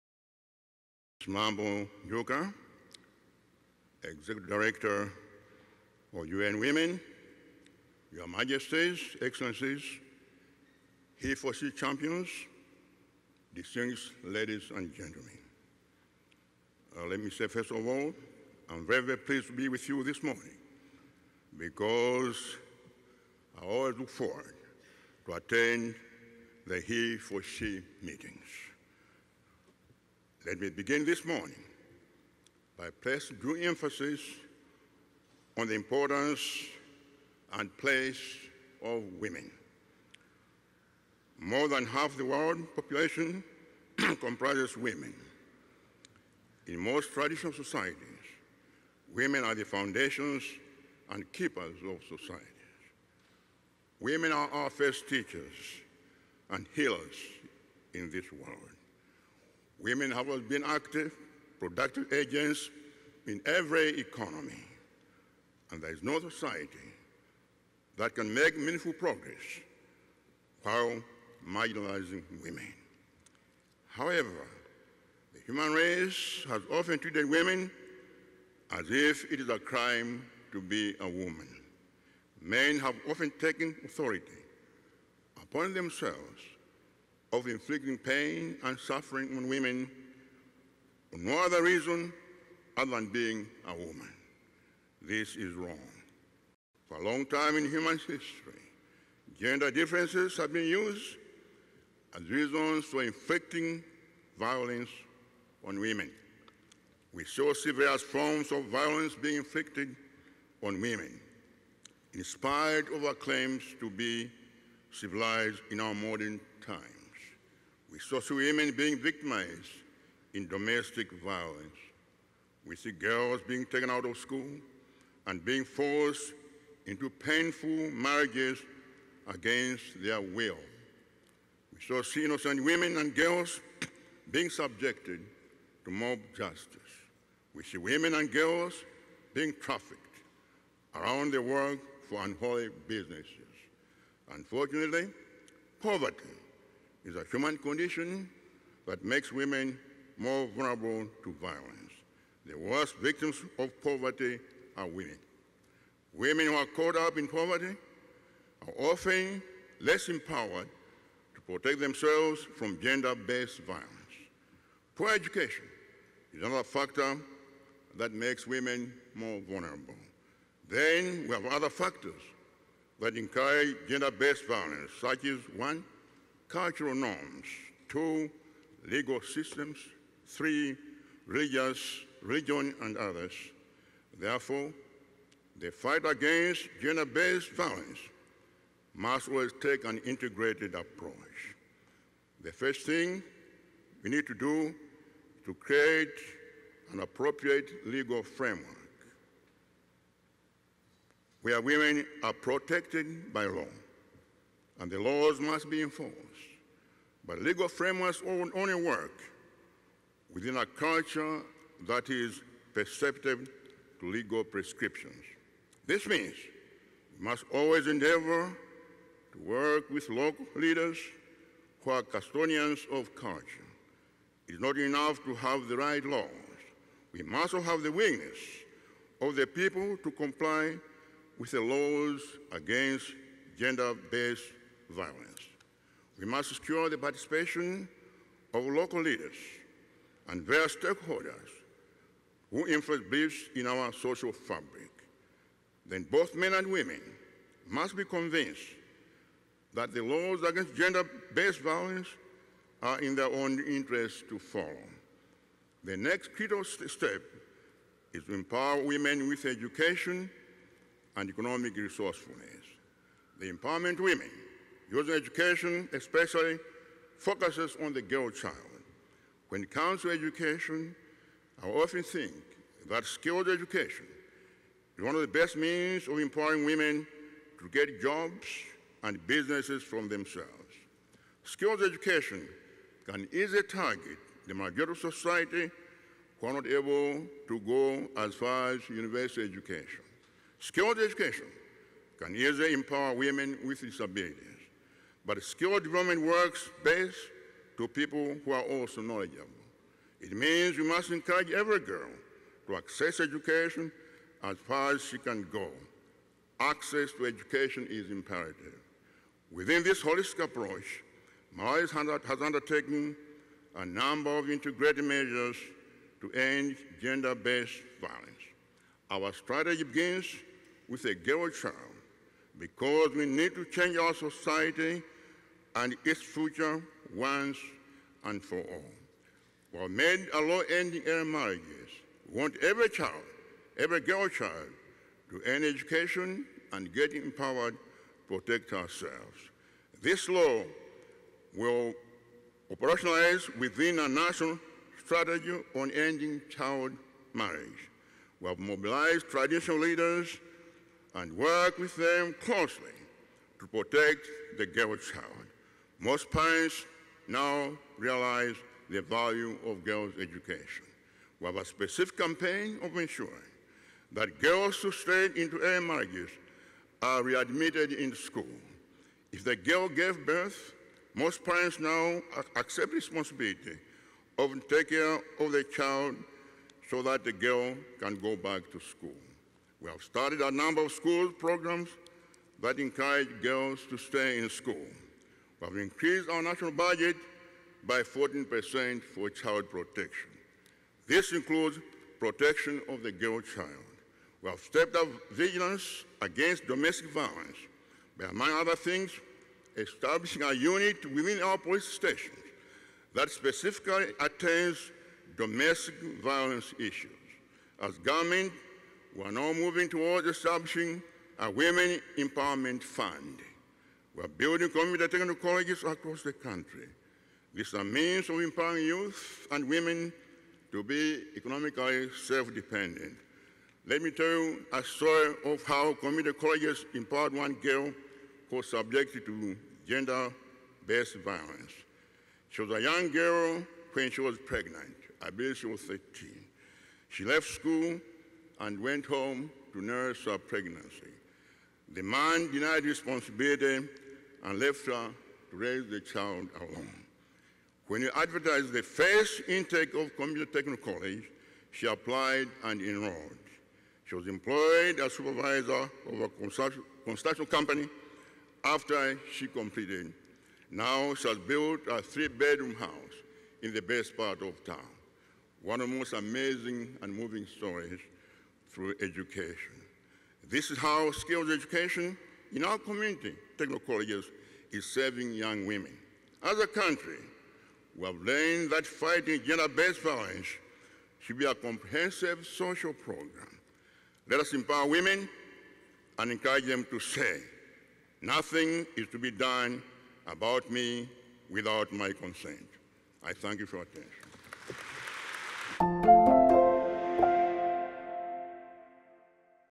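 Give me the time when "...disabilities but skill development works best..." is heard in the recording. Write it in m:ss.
4:53.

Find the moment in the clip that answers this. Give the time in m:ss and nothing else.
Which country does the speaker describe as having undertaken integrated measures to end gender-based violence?
5:11.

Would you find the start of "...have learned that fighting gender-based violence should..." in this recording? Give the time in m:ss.
7:58.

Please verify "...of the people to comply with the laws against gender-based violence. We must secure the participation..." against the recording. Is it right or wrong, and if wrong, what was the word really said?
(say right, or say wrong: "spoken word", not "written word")
right.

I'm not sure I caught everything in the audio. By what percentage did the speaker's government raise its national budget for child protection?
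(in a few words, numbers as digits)
14%.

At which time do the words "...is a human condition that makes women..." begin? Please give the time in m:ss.
2:27.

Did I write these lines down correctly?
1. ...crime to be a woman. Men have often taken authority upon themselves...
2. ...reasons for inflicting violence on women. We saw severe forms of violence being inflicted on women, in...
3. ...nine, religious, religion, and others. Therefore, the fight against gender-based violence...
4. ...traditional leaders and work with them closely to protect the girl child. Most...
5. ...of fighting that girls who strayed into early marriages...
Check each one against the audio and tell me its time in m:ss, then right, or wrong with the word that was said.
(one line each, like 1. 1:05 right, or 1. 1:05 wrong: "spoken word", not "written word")
1. 1:19 right
2. 1:42 right
3. 3:00 wrong: "three", not "nine"
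4. 5:49 right
5. 6:02 wrong: "ensuring", not "fighting".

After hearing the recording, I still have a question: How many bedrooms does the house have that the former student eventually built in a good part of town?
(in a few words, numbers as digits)
3.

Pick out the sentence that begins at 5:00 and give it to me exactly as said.
It means we must encourage every girl to access education as far as she can go.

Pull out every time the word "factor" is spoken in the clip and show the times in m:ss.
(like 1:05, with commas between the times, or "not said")
2:46, 2:51.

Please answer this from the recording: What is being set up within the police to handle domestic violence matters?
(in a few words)
A unit.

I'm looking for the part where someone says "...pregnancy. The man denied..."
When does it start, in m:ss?
7:20.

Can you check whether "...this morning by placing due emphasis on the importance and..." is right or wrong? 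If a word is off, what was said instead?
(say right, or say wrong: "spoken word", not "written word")
right.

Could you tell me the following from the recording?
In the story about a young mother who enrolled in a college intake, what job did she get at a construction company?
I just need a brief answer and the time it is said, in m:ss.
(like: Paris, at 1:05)
Supervisor, at 7:35.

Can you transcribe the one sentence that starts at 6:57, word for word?
This is a means of empowering youth and women to be economically self-dependent.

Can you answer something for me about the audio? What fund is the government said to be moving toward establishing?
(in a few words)
Women Empowerment Fund.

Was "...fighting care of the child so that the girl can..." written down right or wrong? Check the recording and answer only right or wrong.
wrong.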